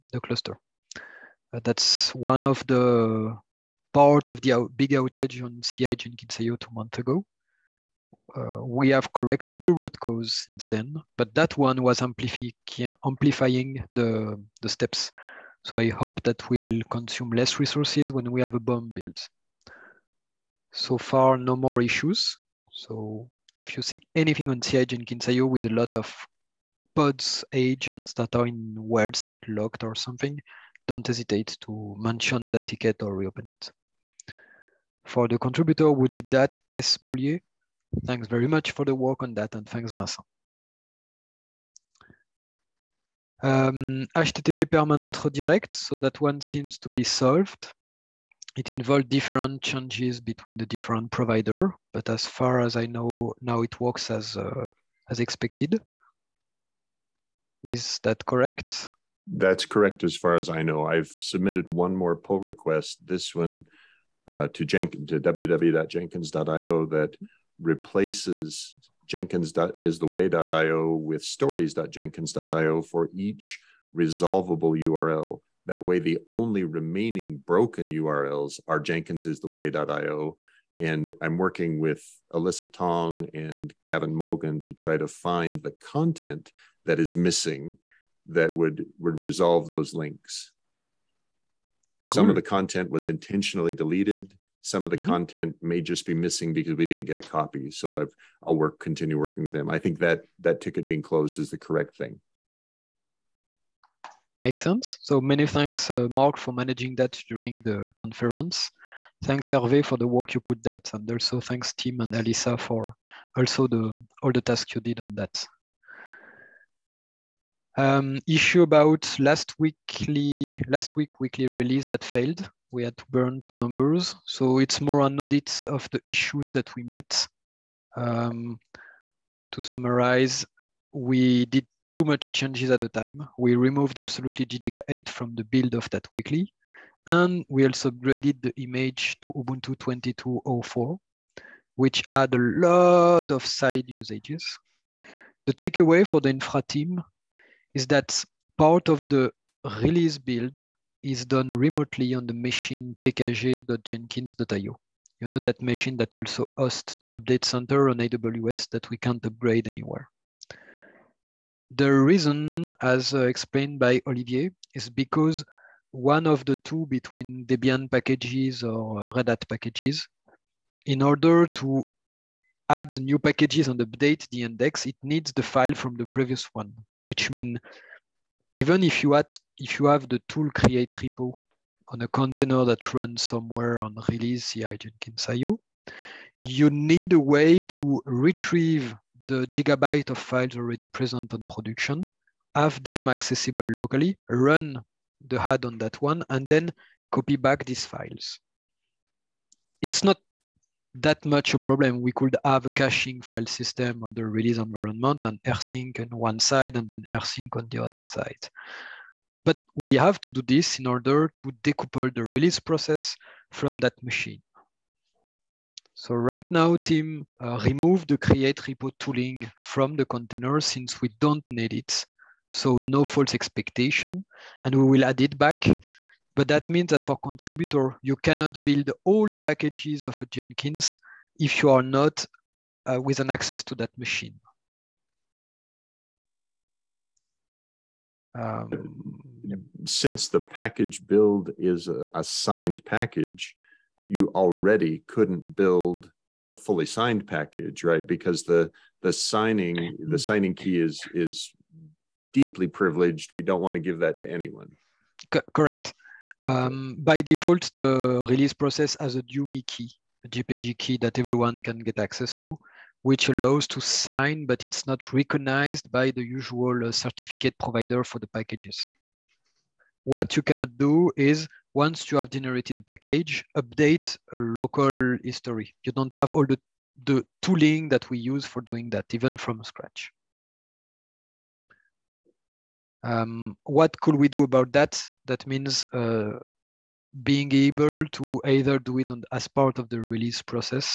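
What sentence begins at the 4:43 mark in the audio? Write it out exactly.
Um, what could we do about that?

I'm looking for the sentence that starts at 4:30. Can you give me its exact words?
What you cannot do is once you have generated a package, update a local history.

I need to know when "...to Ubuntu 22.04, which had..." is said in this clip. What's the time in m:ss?
2:19.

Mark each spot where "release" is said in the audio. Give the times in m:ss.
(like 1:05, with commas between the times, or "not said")
2:01, 2:29, 3:04, 3:24, 3:32, 4:18, 4:50.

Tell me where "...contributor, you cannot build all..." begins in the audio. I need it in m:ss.
3:47.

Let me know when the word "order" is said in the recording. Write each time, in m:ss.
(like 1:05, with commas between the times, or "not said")
2:51, 3:30.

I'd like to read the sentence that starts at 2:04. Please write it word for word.
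So it's more an audit of the issues that we met.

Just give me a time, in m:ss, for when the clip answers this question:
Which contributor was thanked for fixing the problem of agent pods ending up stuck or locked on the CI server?
0:36.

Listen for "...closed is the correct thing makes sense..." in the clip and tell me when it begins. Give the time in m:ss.
1:41.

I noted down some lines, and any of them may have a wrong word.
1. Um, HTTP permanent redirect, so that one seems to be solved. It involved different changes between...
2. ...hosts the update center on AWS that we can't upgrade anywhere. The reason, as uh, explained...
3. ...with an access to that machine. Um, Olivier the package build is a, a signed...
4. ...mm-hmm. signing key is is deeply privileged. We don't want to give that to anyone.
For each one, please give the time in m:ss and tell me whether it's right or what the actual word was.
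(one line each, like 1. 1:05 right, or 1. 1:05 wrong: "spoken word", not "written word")
1. 0:43 right
2. 2:36 right
3. 3:53 wrong: "Since", not "Olivier"
4. 4:10 right.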